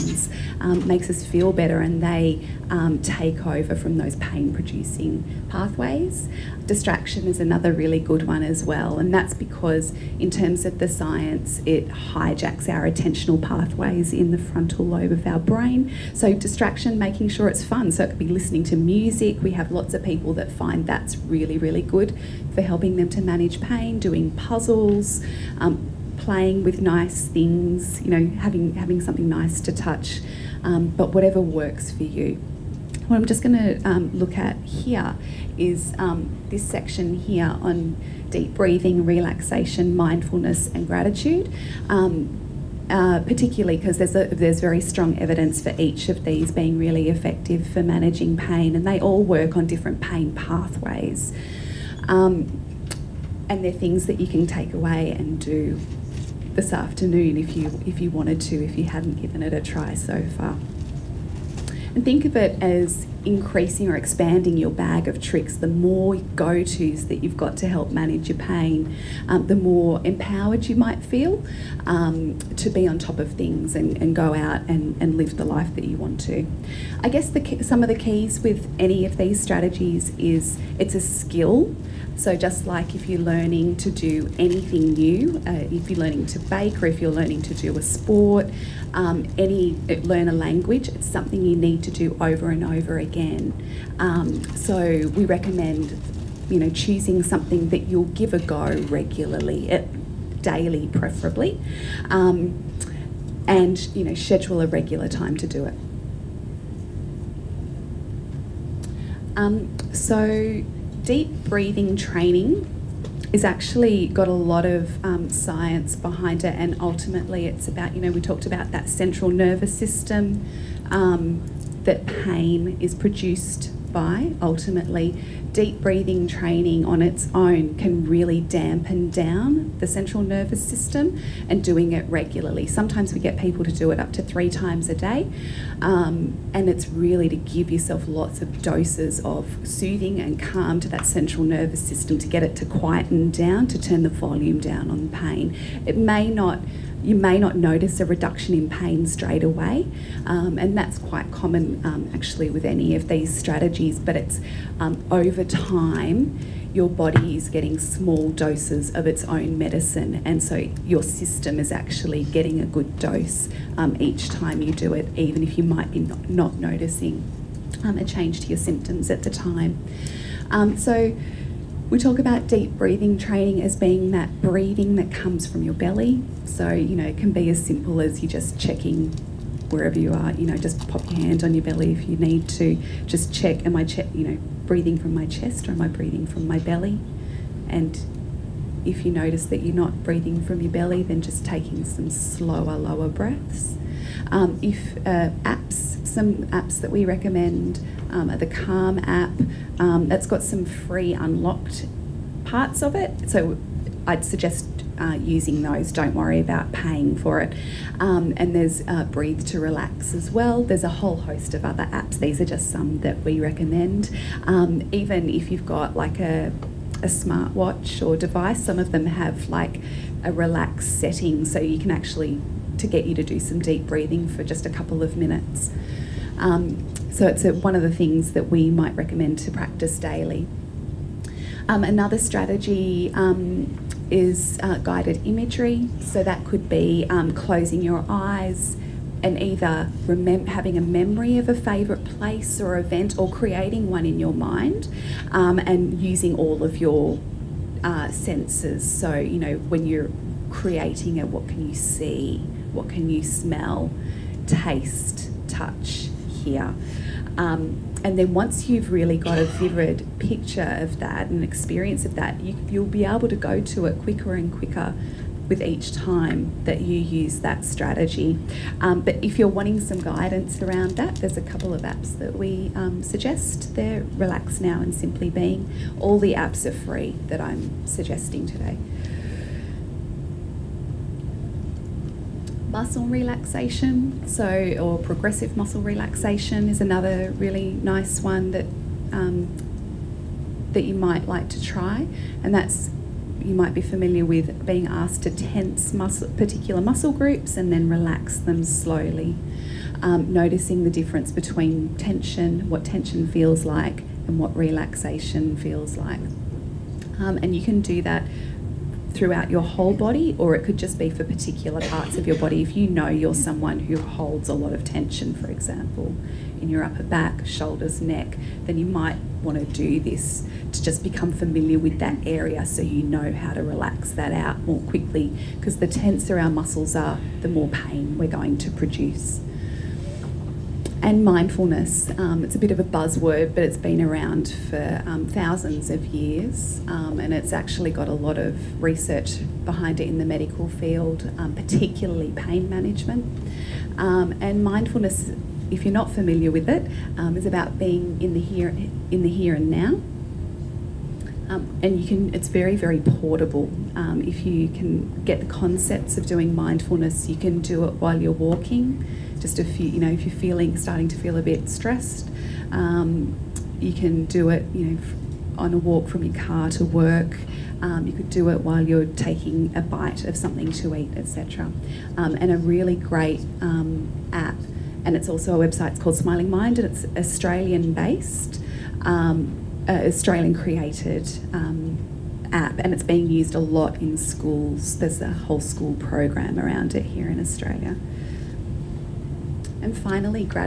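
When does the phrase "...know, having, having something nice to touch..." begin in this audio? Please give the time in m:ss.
0:28.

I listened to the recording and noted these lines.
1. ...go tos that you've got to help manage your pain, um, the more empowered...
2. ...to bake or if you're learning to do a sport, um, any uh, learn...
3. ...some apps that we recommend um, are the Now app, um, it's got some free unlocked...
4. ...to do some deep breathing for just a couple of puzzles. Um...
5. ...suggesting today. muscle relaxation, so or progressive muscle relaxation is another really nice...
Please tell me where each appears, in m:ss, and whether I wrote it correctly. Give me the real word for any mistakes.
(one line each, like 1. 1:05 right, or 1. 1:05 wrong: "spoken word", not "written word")
1. 1:06 right
2. 1:26 right
3. 3:16 wrong: "Calm", not "Now"
4. 3:43 wrong: "minutes", not "puzzles"
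5. 4:37 right.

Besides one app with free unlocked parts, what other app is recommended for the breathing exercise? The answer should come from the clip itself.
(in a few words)
Breathe to Relax.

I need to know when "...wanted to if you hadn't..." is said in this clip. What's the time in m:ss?
0:58.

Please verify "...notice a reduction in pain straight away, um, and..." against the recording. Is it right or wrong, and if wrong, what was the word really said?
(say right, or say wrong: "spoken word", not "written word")
right.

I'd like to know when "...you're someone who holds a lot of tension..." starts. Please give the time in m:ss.
5:13.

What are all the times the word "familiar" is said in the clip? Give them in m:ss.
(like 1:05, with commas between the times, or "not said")
4:53, 5:21, 5:46.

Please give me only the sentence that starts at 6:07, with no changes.
Um, you could do it while you're taking a bite of something to eat, etc.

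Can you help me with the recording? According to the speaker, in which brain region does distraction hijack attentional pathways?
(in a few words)
frontal lobe.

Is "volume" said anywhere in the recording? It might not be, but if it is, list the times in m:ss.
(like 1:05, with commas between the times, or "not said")
2:24.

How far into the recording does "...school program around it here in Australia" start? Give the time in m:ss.
6:25.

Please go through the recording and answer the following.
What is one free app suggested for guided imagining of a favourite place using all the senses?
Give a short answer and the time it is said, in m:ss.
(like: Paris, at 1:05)
Relax Now, at 4:34.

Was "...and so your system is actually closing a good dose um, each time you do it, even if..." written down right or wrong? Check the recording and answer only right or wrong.
wrong.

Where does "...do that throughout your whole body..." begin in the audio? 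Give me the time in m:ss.
5:07.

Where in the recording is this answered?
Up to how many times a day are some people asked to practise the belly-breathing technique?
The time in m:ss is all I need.
2:14.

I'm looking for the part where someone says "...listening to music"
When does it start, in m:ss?
0:18.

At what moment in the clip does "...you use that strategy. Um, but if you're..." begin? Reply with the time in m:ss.
4:26.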